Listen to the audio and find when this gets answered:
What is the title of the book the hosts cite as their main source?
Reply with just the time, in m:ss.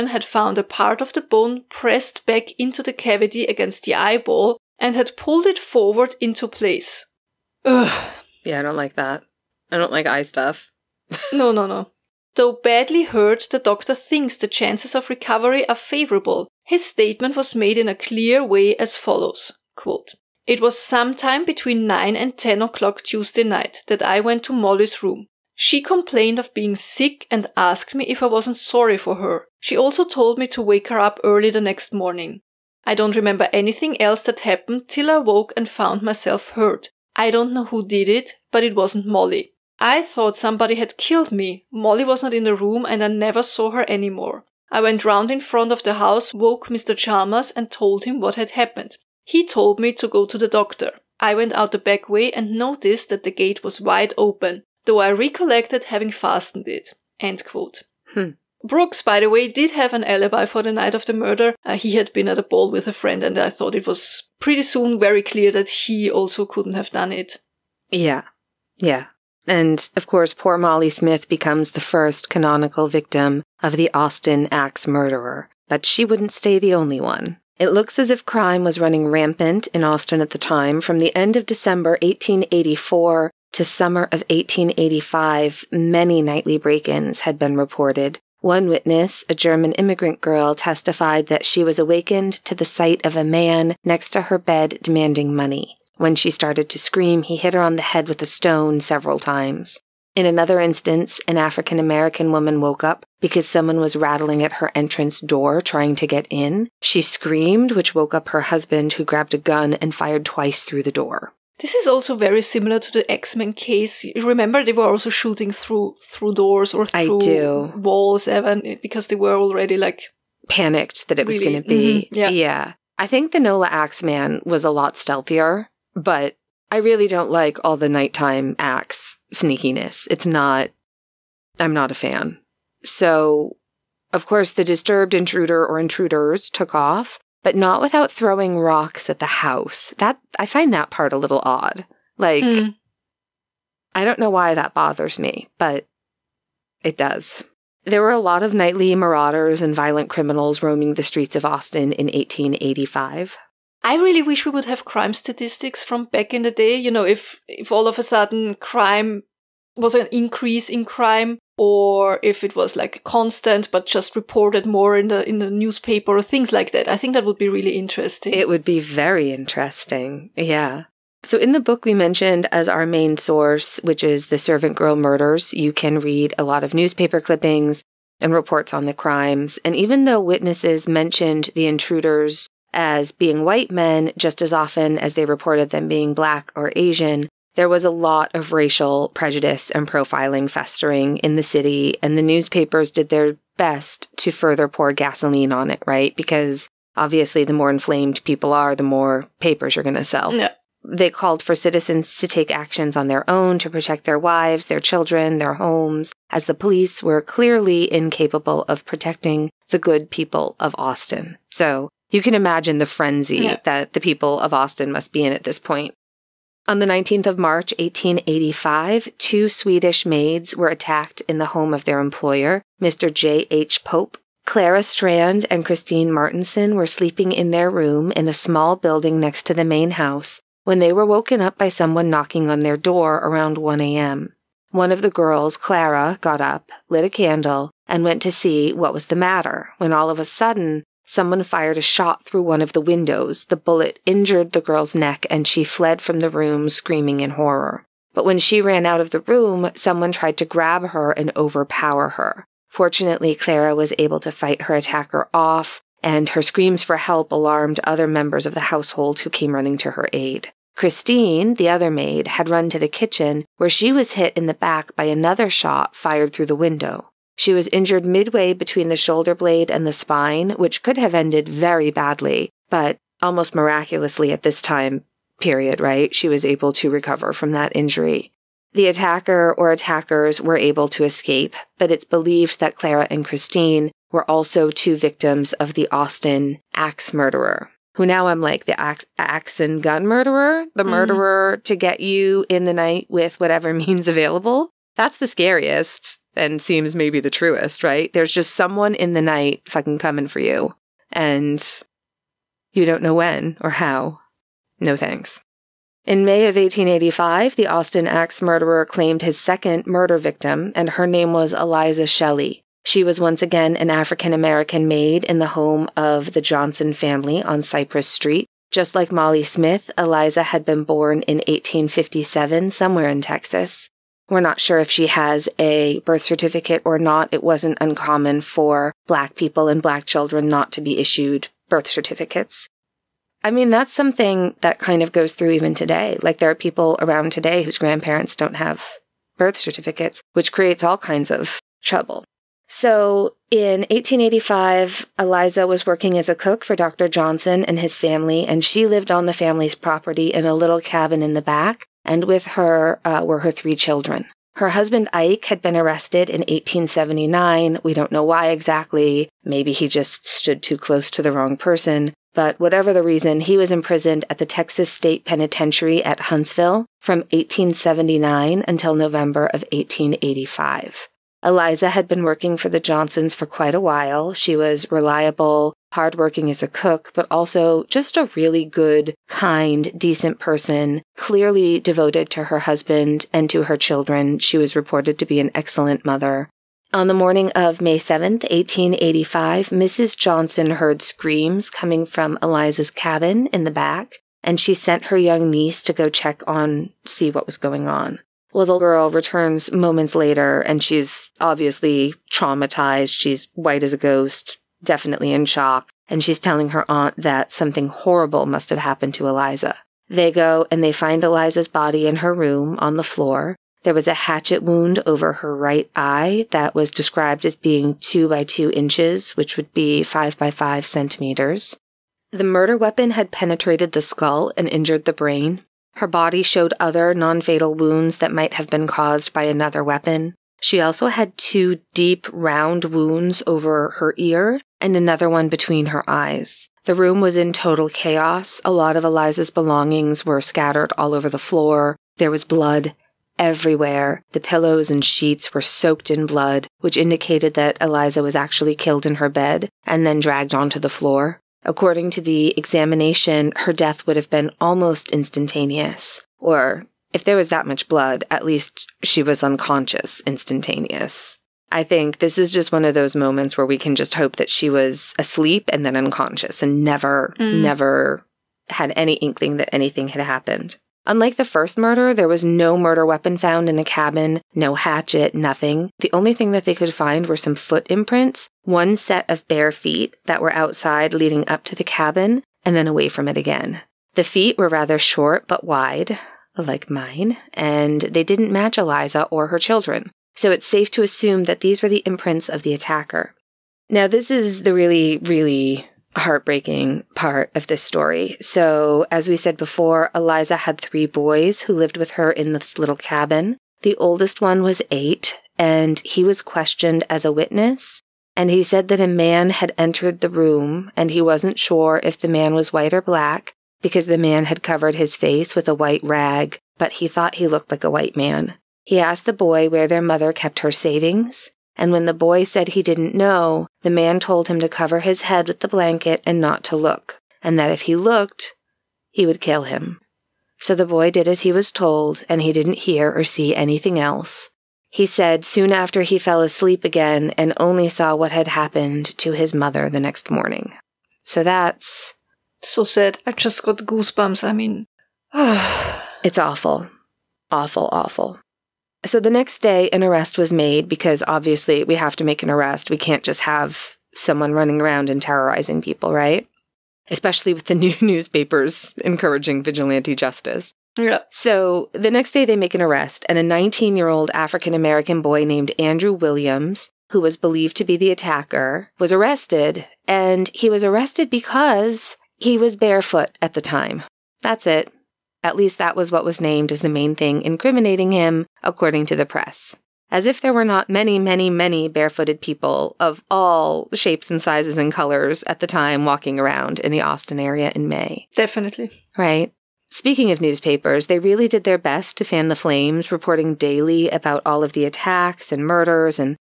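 2:54.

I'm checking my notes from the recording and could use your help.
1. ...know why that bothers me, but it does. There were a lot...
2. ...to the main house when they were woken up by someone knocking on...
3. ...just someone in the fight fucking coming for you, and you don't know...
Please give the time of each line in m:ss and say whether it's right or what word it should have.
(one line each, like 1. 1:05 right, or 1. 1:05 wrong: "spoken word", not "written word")
1. 2:24 right
2. 3:49 right
3. 4:58 wrong: "night", not "fight".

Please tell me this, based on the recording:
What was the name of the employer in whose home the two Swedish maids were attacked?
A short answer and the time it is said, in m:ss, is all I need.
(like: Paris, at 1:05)
J. H. Pope, at 3:43.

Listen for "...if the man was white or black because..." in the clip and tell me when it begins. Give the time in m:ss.
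8:32.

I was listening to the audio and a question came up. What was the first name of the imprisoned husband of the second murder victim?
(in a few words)
Ike.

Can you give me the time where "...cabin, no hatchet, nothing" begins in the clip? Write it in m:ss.
7:53.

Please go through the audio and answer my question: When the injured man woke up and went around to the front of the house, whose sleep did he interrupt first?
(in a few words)
Mr. Chalmers.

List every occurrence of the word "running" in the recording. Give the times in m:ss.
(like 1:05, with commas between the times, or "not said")
1:18, 4:19, 9:14.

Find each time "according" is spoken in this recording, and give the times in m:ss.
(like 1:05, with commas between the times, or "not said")
7:31, 9:38.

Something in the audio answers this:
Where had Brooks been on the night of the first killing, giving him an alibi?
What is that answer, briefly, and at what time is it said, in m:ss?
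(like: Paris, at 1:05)
At a ball, at 1:02.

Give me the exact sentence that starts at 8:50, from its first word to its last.
So the boy did as he was told, and he didn't hear or see anything else.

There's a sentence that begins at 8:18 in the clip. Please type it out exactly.
So, as we said before, Eliza had three boys who lived with her in this little cabin.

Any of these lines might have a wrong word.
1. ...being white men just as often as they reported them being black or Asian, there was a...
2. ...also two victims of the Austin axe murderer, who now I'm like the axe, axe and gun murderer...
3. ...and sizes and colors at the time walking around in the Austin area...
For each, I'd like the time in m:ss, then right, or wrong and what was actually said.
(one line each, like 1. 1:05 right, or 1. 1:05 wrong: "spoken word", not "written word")
1. 3:03 right
2. 4:44 right
3. 9:44 right.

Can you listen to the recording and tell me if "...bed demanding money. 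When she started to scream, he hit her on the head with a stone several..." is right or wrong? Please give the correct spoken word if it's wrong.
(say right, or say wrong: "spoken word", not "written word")
right.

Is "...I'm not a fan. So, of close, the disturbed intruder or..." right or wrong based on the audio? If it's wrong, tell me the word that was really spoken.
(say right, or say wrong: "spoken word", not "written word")
wrong: "course", not "close".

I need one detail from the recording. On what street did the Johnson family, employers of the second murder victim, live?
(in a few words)
Cypress Street.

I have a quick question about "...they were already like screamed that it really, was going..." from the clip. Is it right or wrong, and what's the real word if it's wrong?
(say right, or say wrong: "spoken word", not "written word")
wrong: "panicked", not "screamed".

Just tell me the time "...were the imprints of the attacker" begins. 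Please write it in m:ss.
8:11.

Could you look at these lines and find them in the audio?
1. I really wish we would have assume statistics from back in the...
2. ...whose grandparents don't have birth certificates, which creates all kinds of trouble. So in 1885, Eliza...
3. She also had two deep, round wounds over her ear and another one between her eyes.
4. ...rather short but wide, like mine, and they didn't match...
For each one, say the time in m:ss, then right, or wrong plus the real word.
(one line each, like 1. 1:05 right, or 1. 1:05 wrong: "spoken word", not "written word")
1. 2:33 wrong: "crime", not "assume"
2. 5:37 right
3. 7:10 right
4. 8:04 right.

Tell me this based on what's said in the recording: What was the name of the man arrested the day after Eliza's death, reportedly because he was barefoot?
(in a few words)
Andrew Williams.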